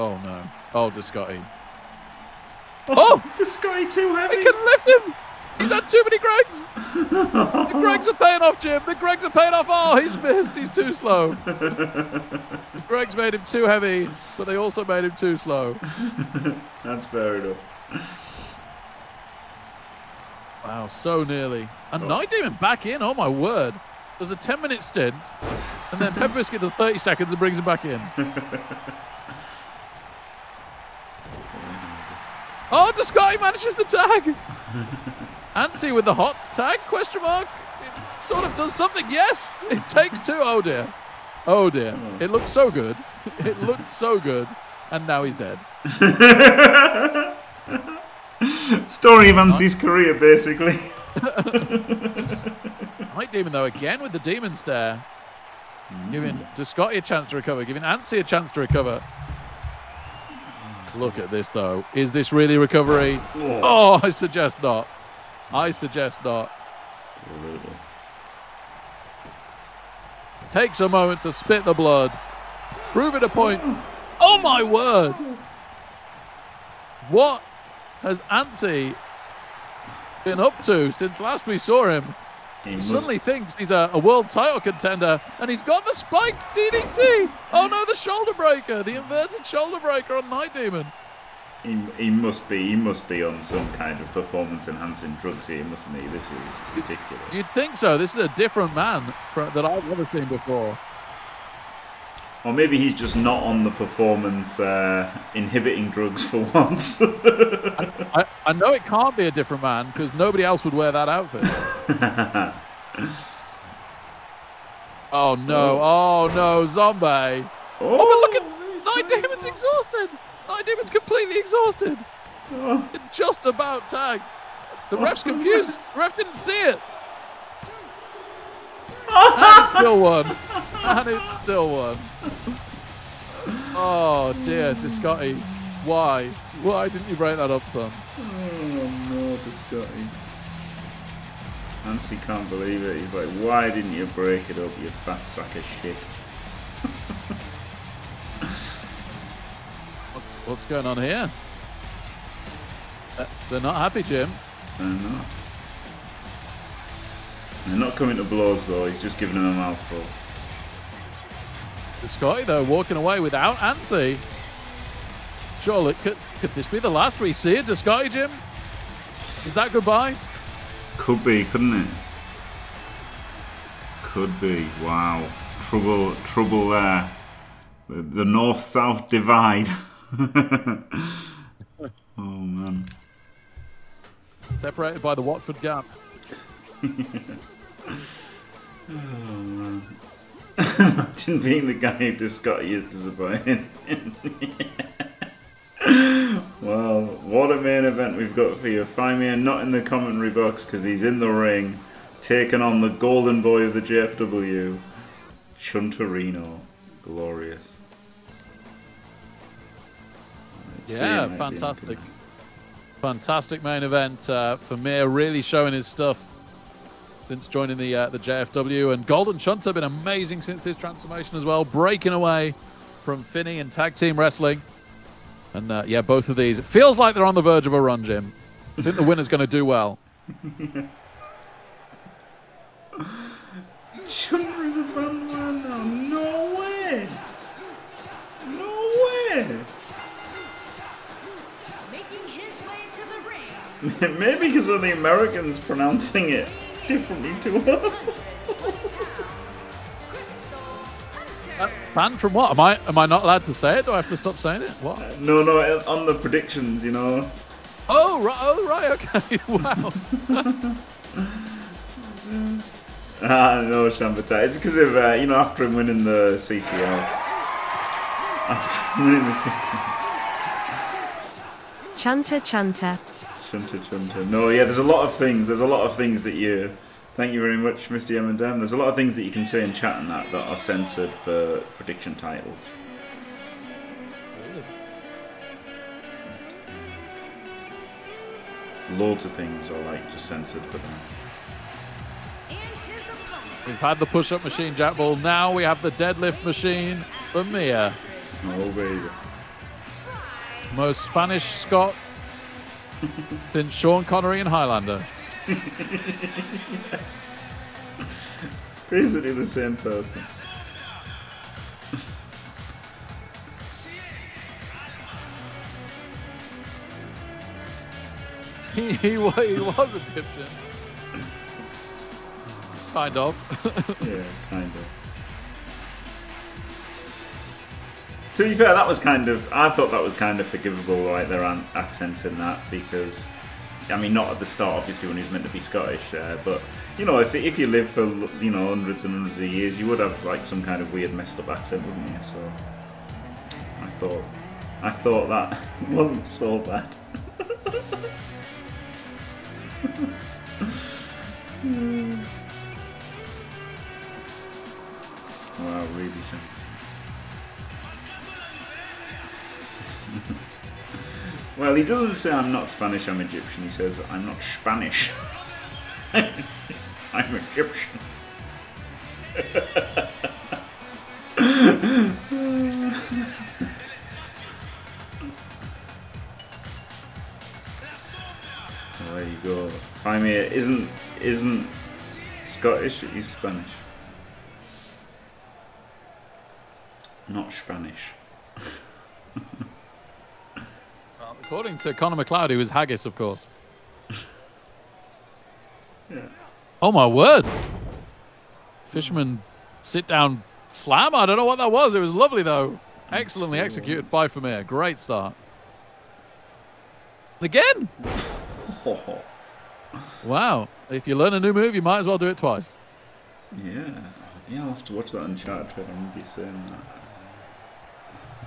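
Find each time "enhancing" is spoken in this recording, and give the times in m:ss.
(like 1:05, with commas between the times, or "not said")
1:34.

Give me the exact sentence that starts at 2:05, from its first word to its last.
The ref didn't see it and still won.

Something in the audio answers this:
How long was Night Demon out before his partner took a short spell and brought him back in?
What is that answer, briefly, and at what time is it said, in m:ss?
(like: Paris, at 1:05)
10 minutes, at 0:24.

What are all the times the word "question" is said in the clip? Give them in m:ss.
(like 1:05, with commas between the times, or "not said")
0:36.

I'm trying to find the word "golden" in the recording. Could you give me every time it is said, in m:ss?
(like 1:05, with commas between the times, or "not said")
3:22, 3:39.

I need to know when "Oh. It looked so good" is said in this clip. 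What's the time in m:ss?
0:41.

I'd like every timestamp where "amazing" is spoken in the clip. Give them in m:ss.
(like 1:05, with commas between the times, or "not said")
3:39.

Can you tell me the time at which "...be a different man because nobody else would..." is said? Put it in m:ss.
1:49.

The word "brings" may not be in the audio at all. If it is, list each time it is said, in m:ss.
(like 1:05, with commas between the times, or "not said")
0:27.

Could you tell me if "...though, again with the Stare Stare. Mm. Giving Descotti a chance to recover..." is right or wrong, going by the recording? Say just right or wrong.
wrong.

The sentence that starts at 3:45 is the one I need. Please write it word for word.
And uh, yeah, both of these.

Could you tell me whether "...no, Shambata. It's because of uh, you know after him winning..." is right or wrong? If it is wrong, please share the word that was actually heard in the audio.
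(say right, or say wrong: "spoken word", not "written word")
right.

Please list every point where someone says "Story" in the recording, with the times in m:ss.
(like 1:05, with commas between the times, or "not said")
0:48.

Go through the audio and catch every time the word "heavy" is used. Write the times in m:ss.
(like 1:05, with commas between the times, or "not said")
0:04, 0:13.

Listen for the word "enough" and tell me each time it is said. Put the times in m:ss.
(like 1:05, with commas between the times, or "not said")
0:17.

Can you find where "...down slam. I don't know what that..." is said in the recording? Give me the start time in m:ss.
6:40.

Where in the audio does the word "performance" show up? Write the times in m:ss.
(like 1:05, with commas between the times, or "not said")
1:34, 1:43.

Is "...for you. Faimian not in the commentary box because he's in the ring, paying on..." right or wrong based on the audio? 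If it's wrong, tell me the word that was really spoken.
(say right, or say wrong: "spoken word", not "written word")
wrong: "taking", not "paying".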